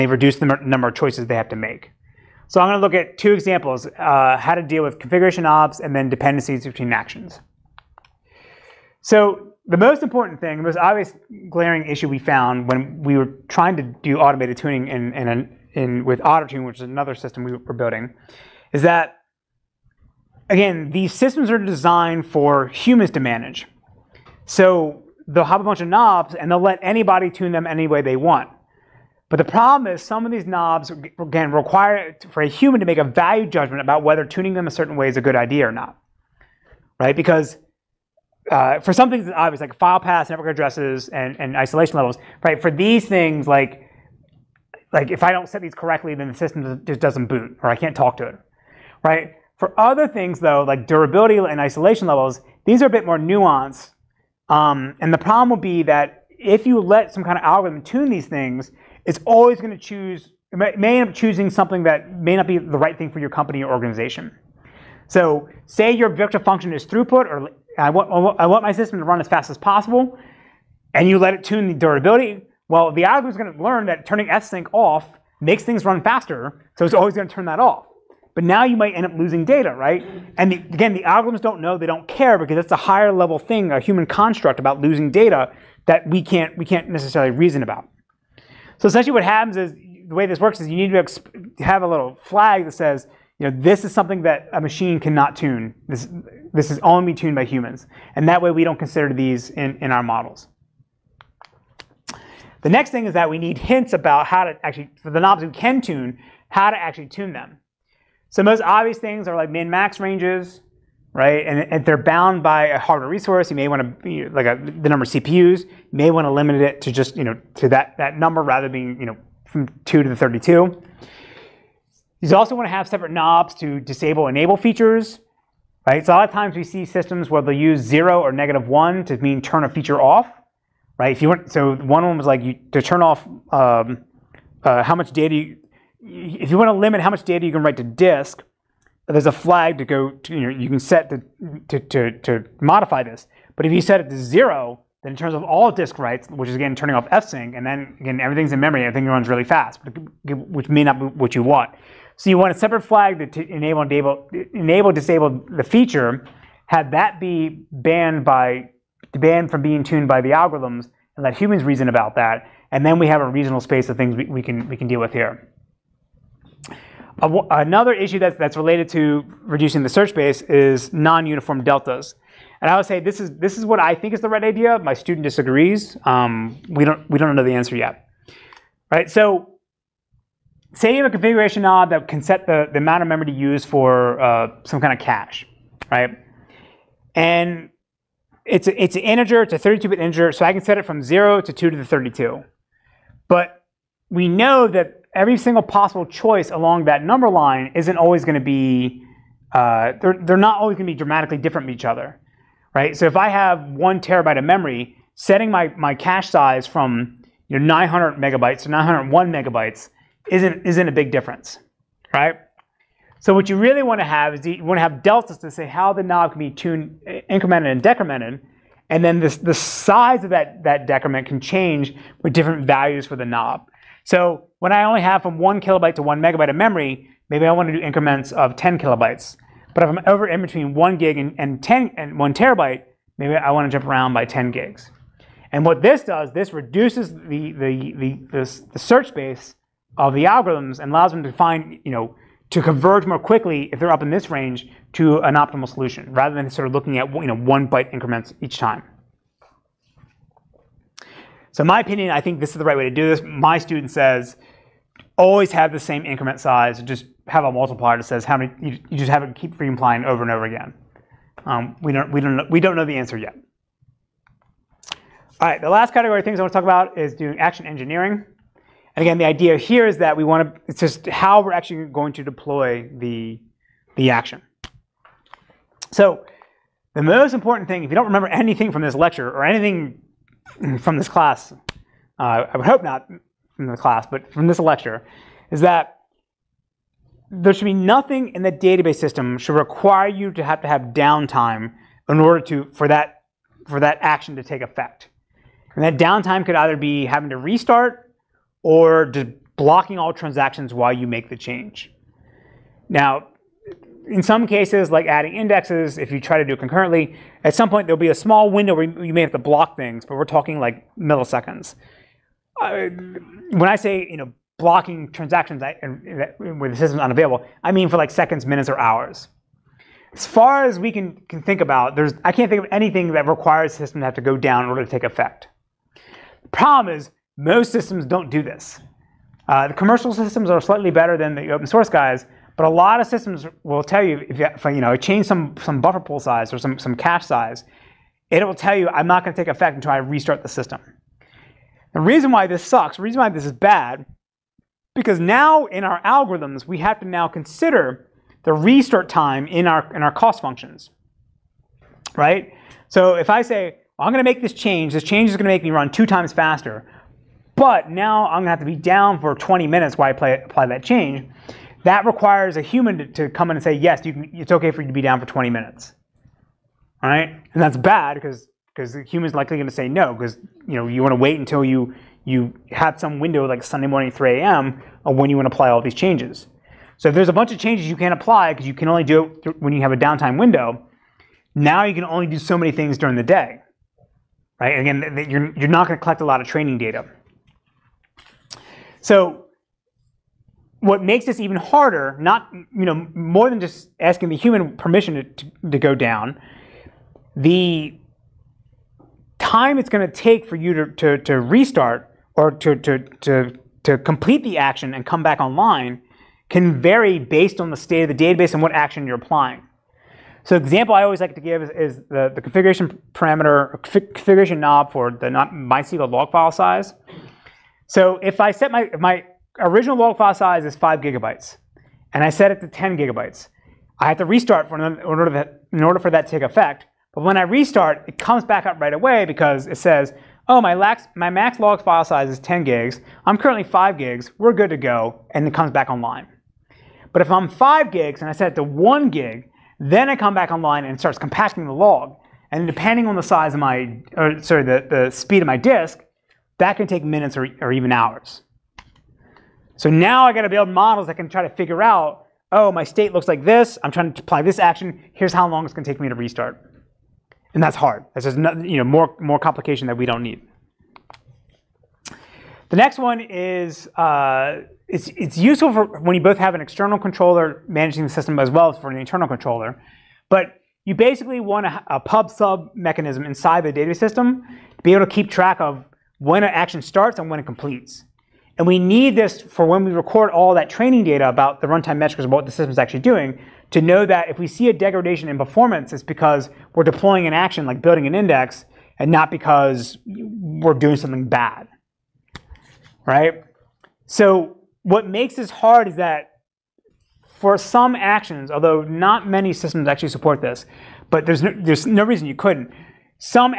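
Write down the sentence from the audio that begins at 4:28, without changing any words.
And again, the idea here is that we want to, it's just how we're actually going to deploy the, the action.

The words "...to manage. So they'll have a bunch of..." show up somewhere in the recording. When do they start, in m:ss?
0:23.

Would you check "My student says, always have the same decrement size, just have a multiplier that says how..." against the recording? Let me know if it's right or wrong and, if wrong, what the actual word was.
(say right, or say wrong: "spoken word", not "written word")
wrong: "increment", not "decrement".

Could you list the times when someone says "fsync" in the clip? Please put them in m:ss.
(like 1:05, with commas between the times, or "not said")
1:14, 2:27.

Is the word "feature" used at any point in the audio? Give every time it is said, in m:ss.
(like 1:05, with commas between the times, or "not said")
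2:04, 2:09, 2:35.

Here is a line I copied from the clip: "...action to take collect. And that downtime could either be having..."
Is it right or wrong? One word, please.
wrong.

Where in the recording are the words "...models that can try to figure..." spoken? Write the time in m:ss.
7:30.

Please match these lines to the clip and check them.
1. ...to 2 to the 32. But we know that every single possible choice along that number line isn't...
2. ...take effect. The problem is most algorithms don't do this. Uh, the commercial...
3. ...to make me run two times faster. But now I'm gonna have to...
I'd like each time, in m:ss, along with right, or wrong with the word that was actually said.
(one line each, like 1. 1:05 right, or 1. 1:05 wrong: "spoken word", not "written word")
1. 3:11 right
2. 5:24 wrong: "systems", not "algorithms"
3. 5:55 right.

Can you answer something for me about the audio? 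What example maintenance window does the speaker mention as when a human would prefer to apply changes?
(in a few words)
Sunday morning 3 a.m.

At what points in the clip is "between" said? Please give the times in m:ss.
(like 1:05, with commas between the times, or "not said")
0:06, 3:50.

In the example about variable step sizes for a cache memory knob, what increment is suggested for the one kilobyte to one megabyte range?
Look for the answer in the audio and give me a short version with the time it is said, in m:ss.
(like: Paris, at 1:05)
10 kilobytes, at 3:48.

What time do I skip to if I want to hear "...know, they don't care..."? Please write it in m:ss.
1:21.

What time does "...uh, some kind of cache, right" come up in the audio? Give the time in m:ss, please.
3:04.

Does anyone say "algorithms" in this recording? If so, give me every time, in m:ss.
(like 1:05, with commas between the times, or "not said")
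0:57, 1:13, 1:21, 2:40, 4:00, 5:46.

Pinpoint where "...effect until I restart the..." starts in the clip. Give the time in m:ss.
5:39.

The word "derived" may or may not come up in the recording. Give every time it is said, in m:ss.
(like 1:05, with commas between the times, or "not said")
not said.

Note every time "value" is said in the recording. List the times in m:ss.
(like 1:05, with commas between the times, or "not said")
0:33, 3:42.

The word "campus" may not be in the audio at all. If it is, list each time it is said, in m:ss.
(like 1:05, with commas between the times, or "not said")
not said.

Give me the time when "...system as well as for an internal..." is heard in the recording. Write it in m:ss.
7:48.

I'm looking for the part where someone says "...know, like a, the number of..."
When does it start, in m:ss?
1:54.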